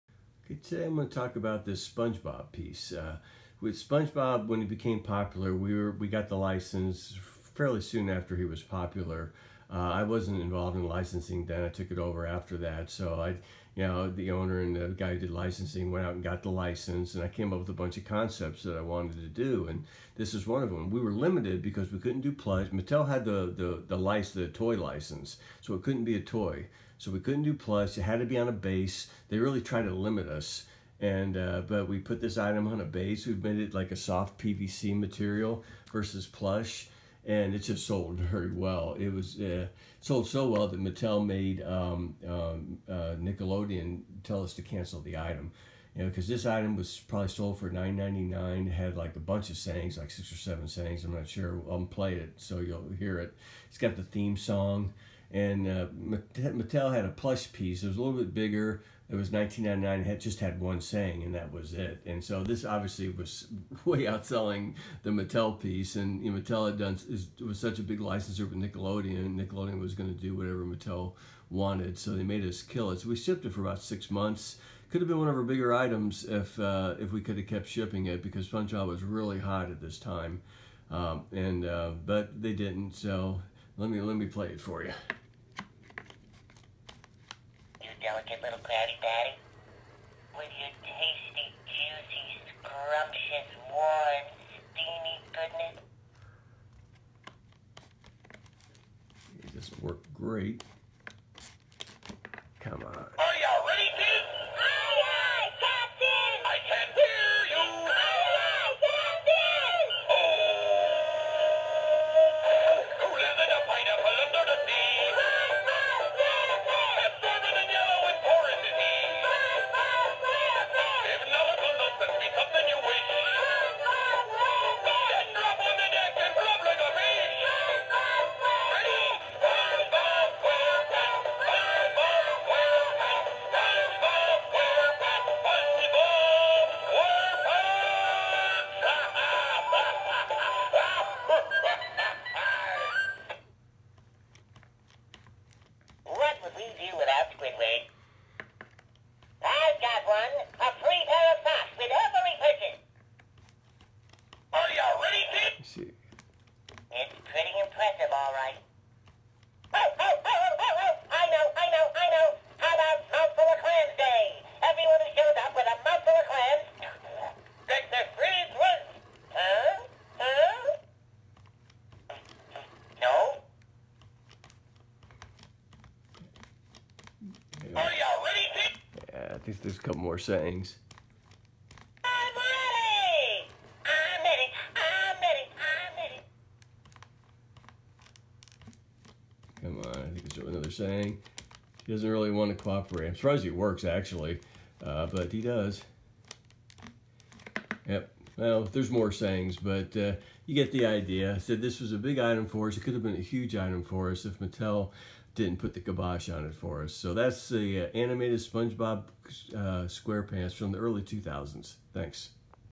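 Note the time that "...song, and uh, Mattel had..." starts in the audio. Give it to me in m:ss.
0:54.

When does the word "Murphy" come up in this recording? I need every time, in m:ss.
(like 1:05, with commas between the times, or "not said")
not said.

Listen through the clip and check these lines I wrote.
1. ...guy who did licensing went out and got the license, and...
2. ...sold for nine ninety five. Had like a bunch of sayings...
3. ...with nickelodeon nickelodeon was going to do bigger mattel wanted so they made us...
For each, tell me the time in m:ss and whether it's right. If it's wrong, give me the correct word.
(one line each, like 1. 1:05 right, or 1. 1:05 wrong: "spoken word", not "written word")
1. 0:14 right
2. 0:47 wrong: "nine", not "five"
3. 1:08 wrong: "whatever", not "bigger".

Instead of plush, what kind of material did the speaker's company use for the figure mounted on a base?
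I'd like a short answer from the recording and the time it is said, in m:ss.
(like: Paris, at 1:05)
soft PVC, at 0:33.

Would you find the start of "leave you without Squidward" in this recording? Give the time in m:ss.
2:26.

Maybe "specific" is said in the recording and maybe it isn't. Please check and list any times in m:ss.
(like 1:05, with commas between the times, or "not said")
not said.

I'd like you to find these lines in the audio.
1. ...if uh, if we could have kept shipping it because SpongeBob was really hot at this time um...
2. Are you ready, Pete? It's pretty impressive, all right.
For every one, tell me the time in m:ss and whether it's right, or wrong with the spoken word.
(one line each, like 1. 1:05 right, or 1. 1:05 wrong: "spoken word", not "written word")
1. 1:16 right
2. 2:34 right.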